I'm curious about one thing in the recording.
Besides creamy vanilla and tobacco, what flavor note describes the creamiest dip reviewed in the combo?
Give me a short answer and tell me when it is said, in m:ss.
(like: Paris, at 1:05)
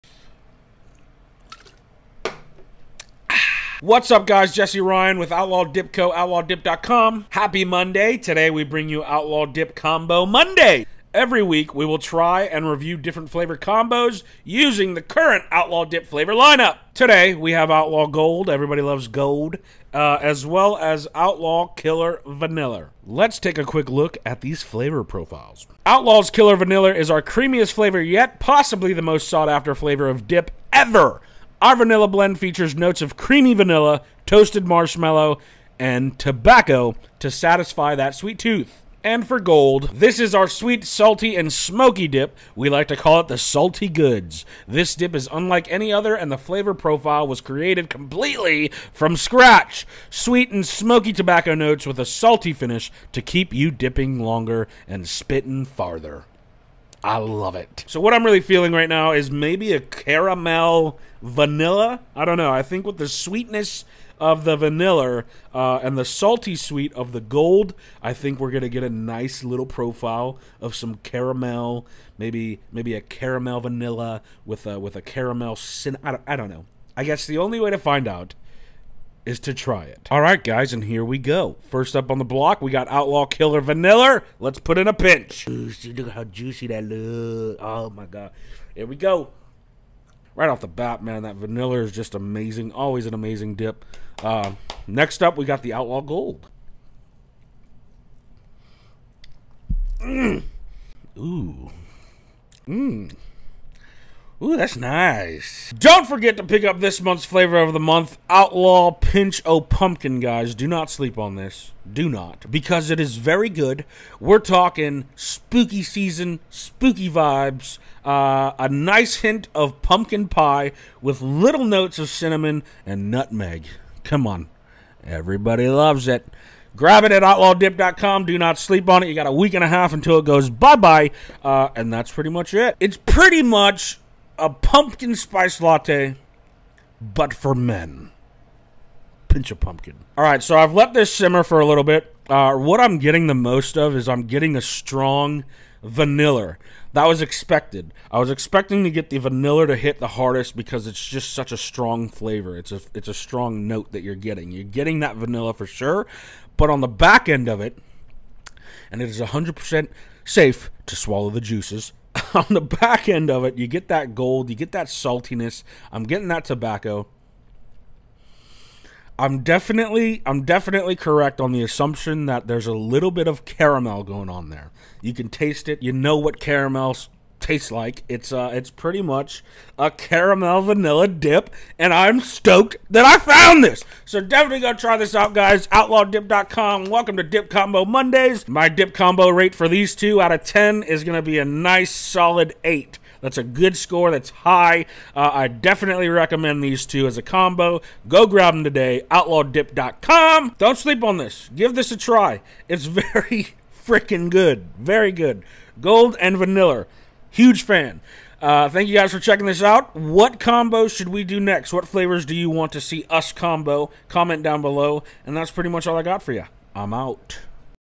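toasted marshmallow, at 0:34.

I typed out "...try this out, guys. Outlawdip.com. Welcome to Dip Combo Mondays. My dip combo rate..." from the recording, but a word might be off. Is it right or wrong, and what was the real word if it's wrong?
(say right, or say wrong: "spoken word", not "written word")
right.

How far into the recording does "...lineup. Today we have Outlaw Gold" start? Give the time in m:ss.
0:16.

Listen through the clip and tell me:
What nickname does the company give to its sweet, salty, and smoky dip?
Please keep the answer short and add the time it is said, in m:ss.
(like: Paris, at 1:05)
the Salty Goods, at 0:43.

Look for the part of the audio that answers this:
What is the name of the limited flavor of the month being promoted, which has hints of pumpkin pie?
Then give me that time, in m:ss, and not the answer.
1:48.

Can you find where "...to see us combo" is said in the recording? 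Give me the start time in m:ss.
3:32.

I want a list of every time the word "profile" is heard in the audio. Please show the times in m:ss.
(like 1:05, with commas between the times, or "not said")
0:25, 0:46, 1:09.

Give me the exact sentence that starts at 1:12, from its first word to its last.
Maybe maybe a caramel vanilla with a with a caramel.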